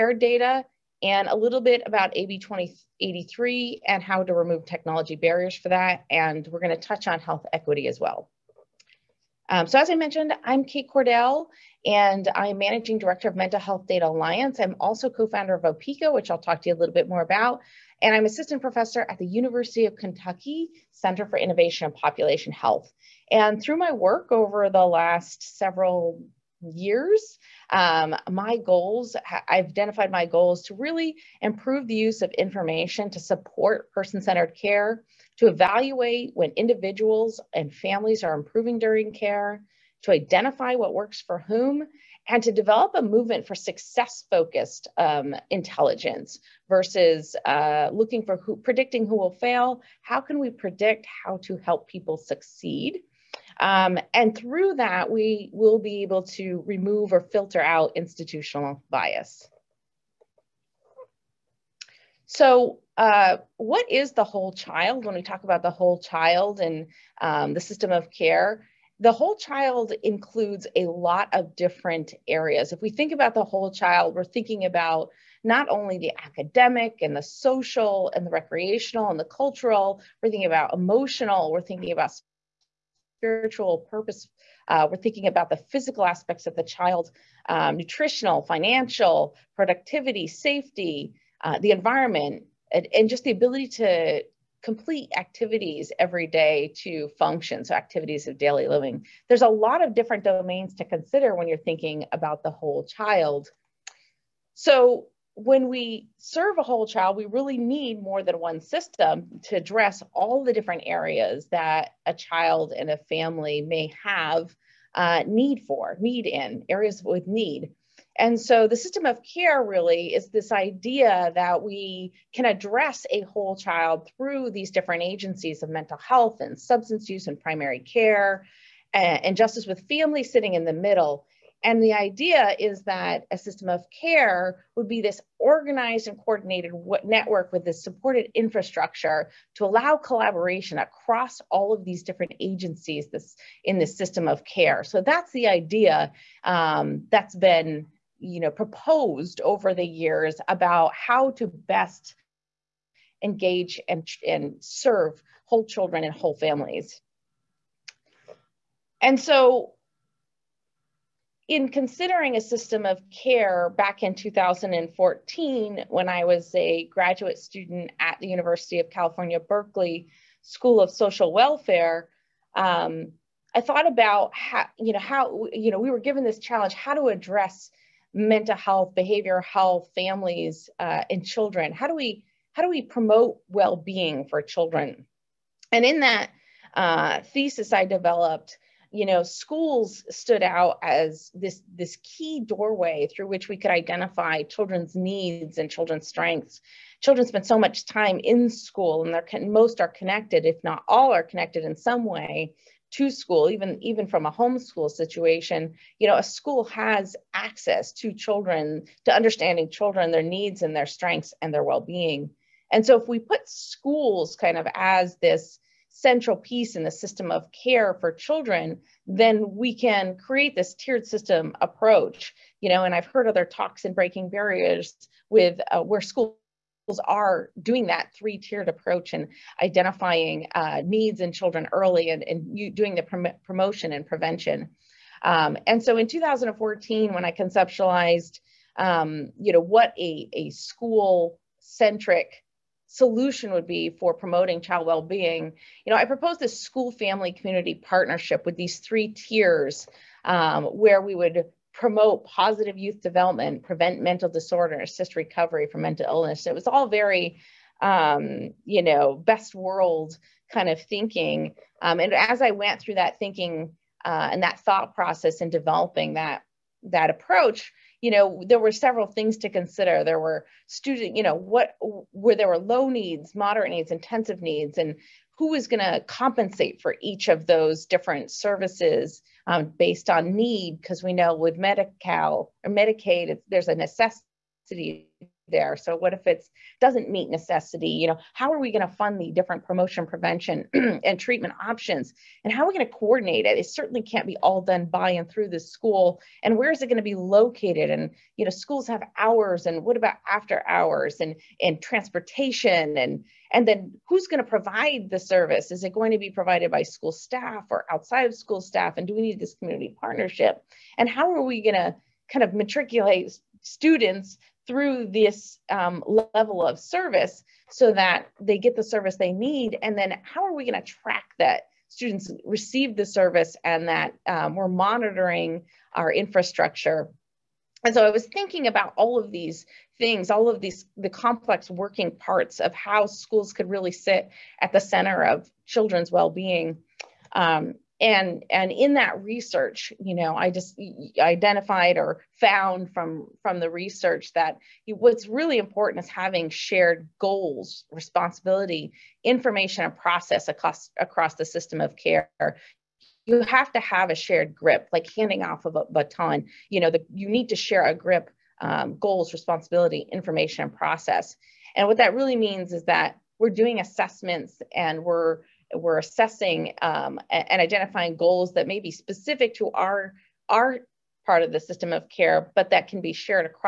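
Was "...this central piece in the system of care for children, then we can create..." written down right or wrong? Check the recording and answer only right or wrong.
right.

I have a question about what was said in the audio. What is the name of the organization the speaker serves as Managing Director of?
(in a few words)
Mental Health Data Alliance.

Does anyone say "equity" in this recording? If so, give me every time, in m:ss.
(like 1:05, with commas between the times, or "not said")
0:07.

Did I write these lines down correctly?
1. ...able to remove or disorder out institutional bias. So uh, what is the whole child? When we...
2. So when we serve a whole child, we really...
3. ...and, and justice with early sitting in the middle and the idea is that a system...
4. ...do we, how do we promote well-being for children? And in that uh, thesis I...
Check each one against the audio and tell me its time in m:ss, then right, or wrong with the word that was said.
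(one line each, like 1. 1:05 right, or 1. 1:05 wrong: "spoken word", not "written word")
1. 0:56 wrong: "filter", not "disorder"
2. 1:44 right
3. 2:08 wrong: "family", not "early"
4. 3:01 right.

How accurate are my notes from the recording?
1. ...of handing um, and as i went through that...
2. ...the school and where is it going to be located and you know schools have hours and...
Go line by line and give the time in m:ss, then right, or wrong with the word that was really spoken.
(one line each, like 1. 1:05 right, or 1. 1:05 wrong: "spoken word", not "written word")
1. 4:20 wrong: "thinking", not "handing"
2. 4:55 right.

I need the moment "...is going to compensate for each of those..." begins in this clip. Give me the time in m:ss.
4:35.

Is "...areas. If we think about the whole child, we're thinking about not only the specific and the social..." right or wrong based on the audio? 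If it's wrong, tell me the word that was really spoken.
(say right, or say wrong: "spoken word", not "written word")
wrong: "academic", not "specific".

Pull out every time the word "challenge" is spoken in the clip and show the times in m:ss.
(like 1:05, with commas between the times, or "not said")
2:56.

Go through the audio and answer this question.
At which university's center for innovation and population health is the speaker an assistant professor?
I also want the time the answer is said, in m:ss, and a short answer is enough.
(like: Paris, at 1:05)
University of Kentucky, at 0:19.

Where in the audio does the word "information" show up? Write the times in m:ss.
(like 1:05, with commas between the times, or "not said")
0:32, 5:49, 6:00.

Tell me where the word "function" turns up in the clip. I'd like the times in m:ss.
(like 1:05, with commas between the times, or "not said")
1:37.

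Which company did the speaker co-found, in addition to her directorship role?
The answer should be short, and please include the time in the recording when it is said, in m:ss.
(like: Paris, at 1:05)
Opeeka, at 0:15.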